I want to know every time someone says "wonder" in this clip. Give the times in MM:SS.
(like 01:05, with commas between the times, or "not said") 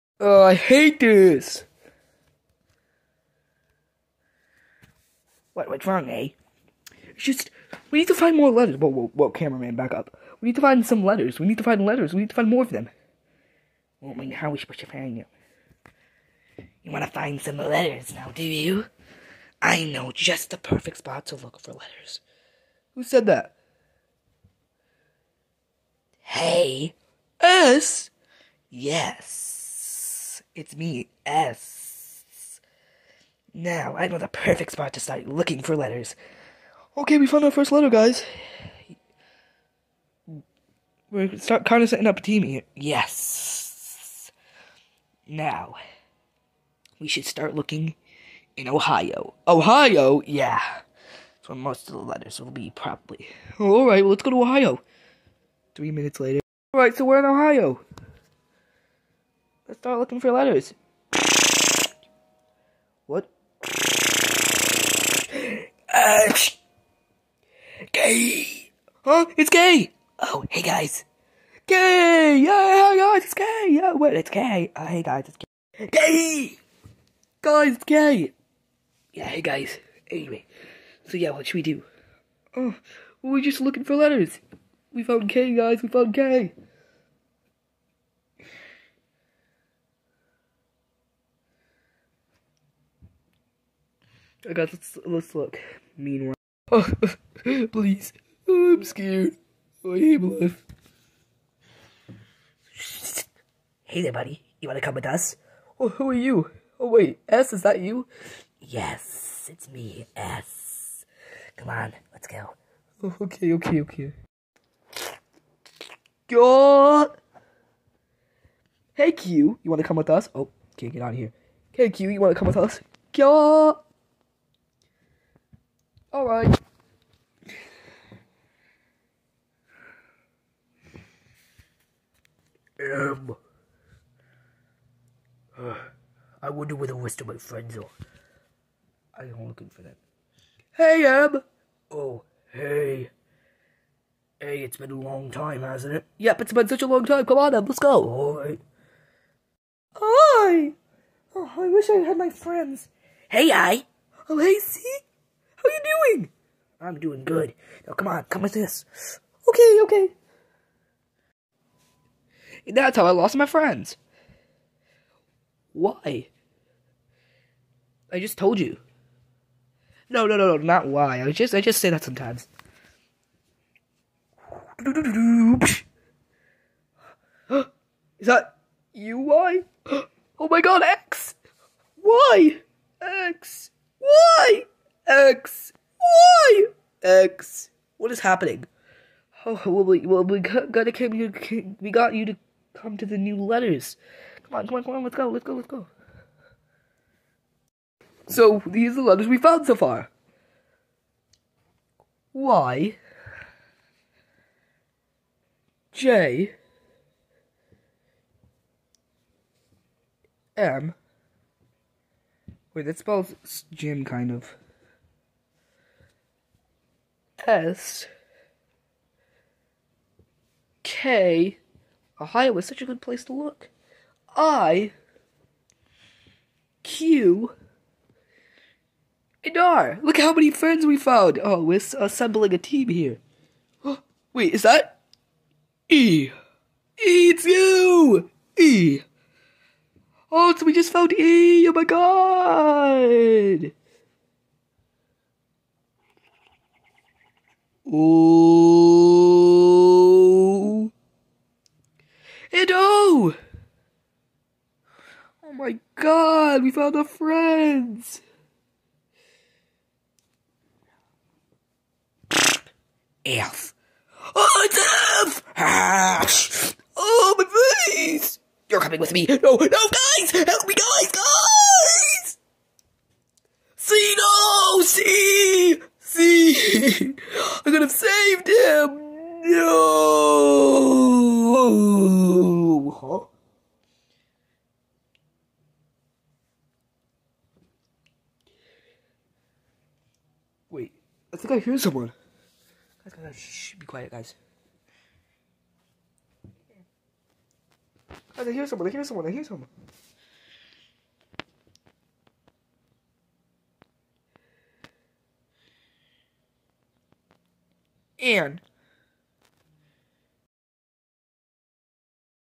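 02:16.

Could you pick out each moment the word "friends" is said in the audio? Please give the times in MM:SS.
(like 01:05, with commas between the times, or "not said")
02:17, 02:32, 02:43, 03:50, 04:17.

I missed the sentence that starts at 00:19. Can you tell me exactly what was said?
I know just the perfect spot to look for letters.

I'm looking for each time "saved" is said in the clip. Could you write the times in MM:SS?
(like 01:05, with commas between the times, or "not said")
04:38.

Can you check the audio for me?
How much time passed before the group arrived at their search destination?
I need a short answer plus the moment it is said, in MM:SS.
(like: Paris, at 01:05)
3 minutes, at 00:55.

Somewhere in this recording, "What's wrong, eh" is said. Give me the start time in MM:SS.
00:05.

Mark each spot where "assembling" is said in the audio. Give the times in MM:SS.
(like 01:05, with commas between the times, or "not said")
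03:52.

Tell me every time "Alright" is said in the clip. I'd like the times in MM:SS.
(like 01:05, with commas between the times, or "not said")
02:06.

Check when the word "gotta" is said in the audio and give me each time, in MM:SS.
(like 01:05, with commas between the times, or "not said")
03:10.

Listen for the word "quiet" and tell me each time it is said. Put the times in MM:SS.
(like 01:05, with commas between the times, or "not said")
04:53.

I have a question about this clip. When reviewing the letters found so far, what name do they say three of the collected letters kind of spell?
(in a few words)
Jim.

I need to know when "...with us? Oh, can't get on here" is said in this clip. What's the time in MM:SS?
01:59.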